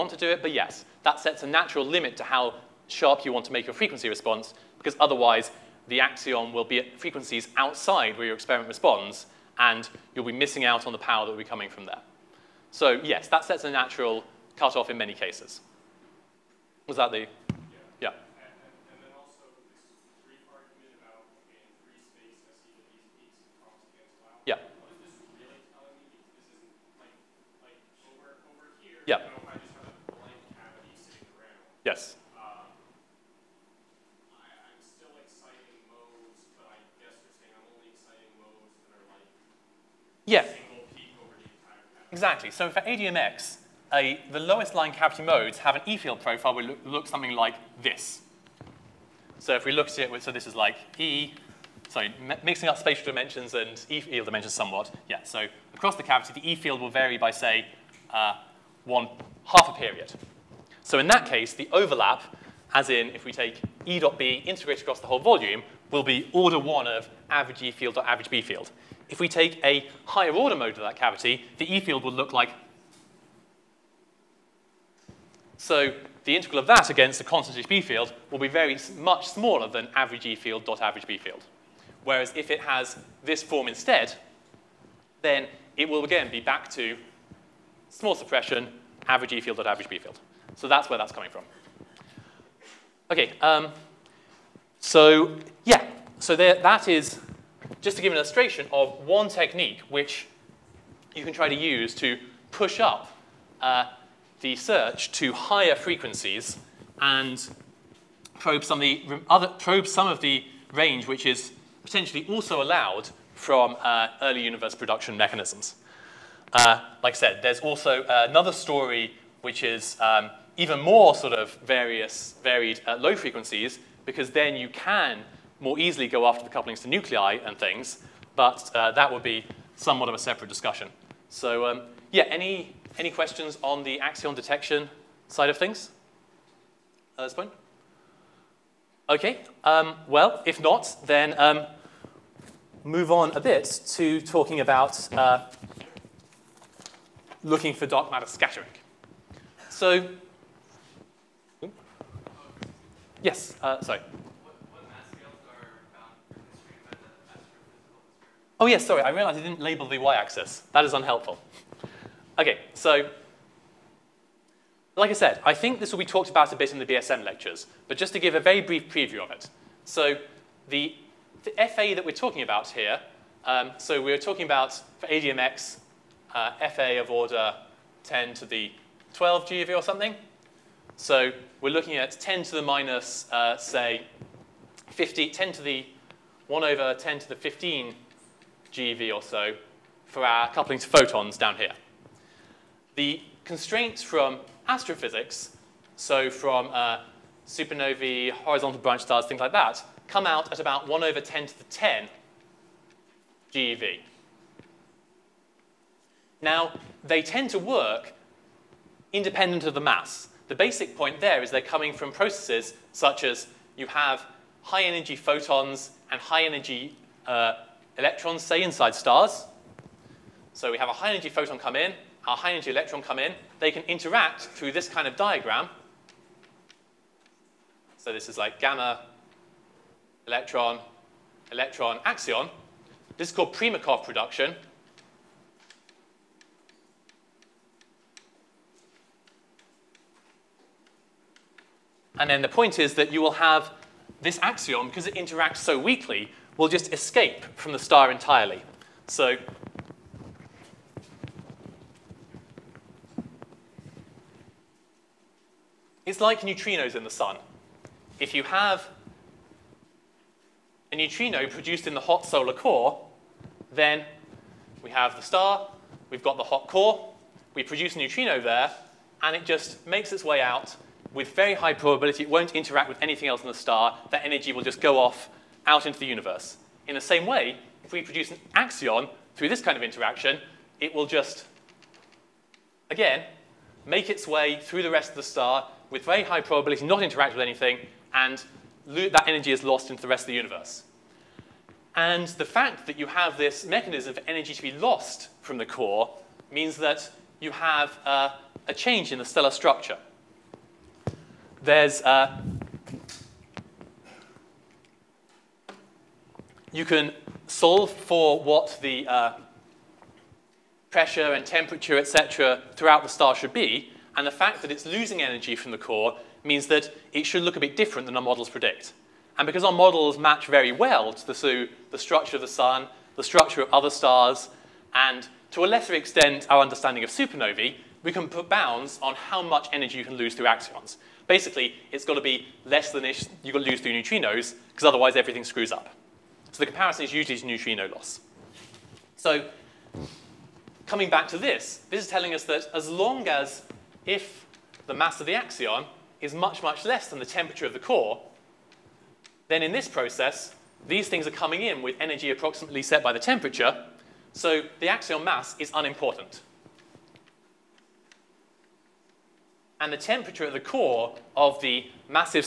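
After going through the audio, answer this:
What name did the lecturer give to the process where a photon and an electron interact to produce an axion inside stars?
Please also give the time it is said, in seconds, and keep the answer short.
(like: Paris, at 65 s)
Primakoff production, at 233 s.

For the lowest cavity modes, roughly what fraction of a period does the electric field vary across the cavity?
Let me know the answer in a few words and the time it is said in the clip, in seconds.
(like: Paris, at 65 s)
one half, at 58 s.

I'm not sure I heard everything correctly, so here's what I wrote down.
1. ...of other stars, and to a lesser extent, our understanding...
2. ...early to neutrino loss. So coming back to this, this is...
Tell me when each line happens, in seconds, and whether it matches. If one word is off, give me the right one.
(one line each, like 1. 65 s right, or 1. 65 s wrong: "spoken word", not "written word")
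1. 323 s right
2. 337 s wrong: "usually", not "early".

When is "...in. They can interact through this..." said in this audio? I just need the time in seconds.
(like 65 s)
223 s.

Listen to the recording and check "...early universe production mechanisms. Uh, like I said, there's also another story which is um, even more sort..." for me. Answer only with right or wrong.
right.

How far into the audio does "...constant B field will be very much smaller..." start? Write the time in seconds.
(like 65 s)
77 s.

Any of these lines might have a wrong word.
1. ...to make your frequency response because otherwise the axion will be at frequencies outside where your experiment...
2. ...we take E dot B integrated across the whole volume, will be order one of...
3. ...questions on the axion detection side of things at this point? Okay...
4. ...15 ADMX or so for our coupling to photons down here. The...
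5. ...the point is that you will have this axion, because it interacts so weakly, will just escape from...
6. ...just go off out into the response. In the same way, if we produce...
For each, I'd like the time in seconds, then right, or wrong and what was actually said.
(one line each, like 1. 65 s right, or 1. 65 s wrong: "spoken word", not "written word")
1. 3 s right
2. 63 s right
3. 133 s right
4. 187 s wrong: "GeV", not "ADMX"
5. 242 s right
6. 274 s wrong: "universe", not "response".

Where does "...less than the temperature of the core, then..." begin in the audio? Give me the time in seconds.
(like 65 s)
346 s.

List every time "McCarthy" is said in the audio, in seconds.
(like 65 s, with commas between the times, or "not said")
not said.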